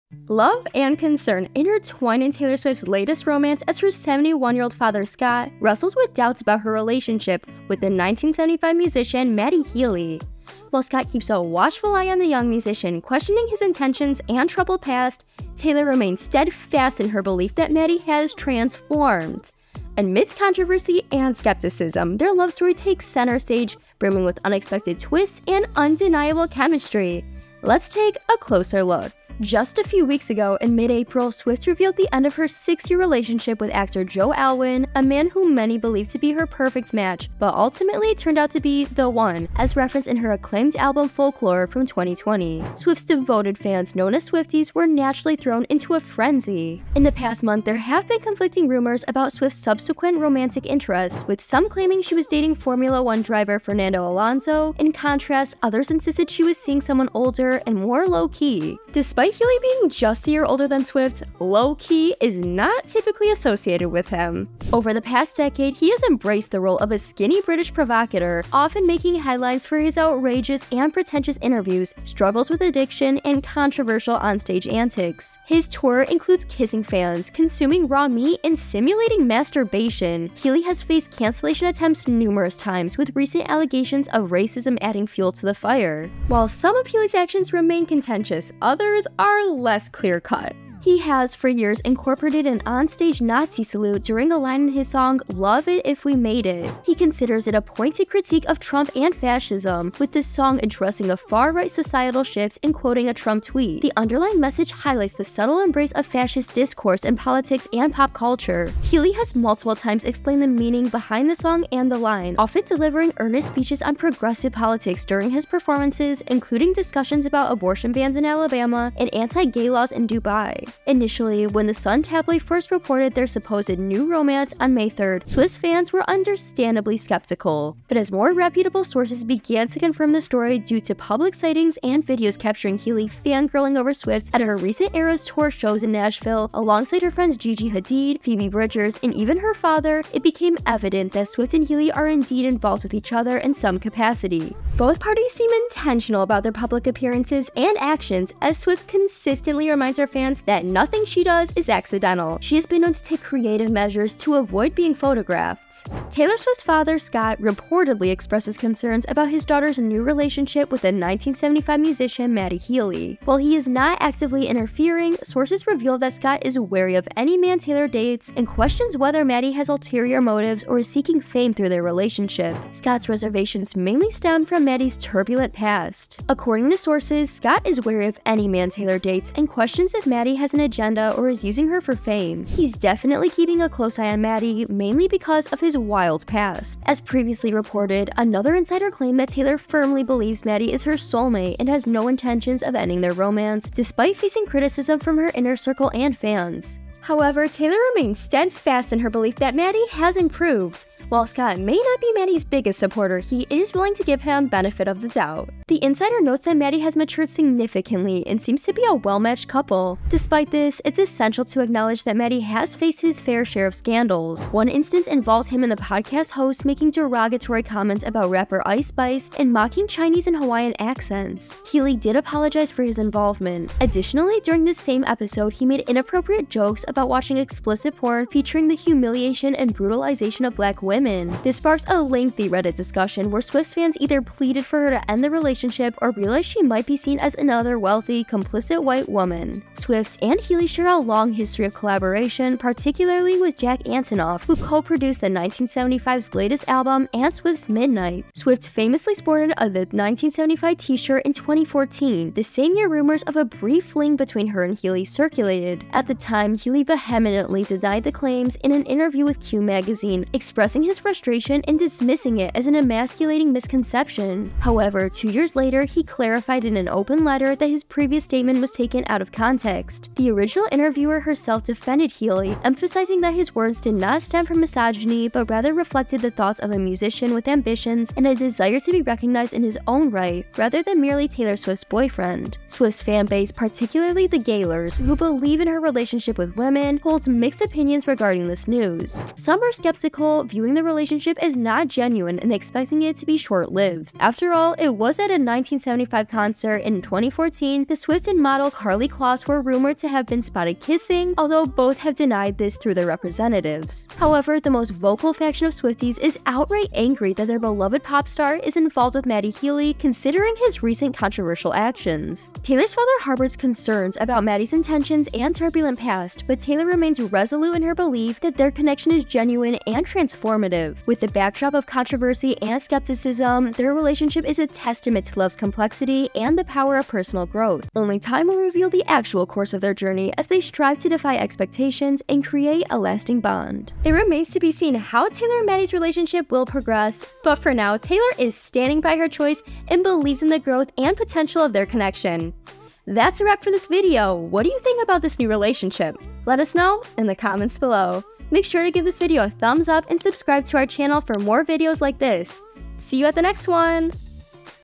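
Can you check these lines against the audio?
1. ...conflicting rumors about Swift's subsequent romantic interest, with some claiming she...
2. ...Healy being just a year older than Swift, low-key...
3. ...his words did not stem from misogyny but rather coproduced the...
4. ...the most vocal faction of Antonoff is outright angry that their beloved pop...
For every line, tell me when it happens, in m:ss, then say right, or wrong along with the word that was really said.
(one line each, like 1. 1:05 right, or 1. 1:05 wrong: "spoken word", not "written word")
1. 0:48 right
2. 0:59 right
3. 4:33 wrong: "reflected", not "coproduced"
4. 5:04 wrong: "Swifties", not "Antonoff".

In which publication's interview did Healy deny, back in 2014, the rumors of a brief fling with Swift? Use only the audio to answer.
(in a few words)
Q magazine.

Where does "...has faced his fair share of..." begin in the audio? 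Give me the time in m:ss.
3:32.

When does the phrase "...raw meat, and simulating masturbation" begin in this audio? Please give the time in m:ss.
1:17.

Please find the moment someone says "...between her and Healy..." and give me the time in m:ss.
4:14.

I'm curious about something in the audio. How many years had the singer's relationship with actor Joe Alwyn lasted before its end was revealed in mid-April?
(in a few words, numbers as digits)
6.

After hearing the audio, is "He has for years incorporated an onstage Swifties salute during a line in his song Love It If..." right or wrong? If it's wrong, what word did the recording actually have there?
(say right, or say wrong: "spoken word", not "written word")
wrong: "Nazi", not "Swifties".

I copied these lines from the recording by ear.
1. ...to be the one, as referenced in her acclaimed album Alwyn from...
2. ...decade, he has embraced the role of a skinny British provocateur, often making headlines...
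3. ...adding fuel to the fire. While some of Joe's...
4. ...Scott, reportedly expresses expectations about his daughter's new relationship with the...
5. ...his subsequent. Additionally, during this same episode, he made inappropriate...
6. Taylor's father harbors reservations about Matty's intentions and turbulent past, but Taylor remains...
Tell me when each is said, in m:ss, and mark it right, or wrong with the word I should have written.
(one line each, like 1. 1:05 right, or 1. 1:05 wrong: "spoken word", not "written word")
1. 0:38 wrong: "Folklore", not "Alwyn"
2. 1:05 right
3. 1:24 wrong: "Healy", not "Joe"
4. 2:36 wrong: "concerns", not "expectations"
5. 3:42 wrong: "involvement", not "subsequent"
6. 5:12 wrong: "concerns", not "reservations".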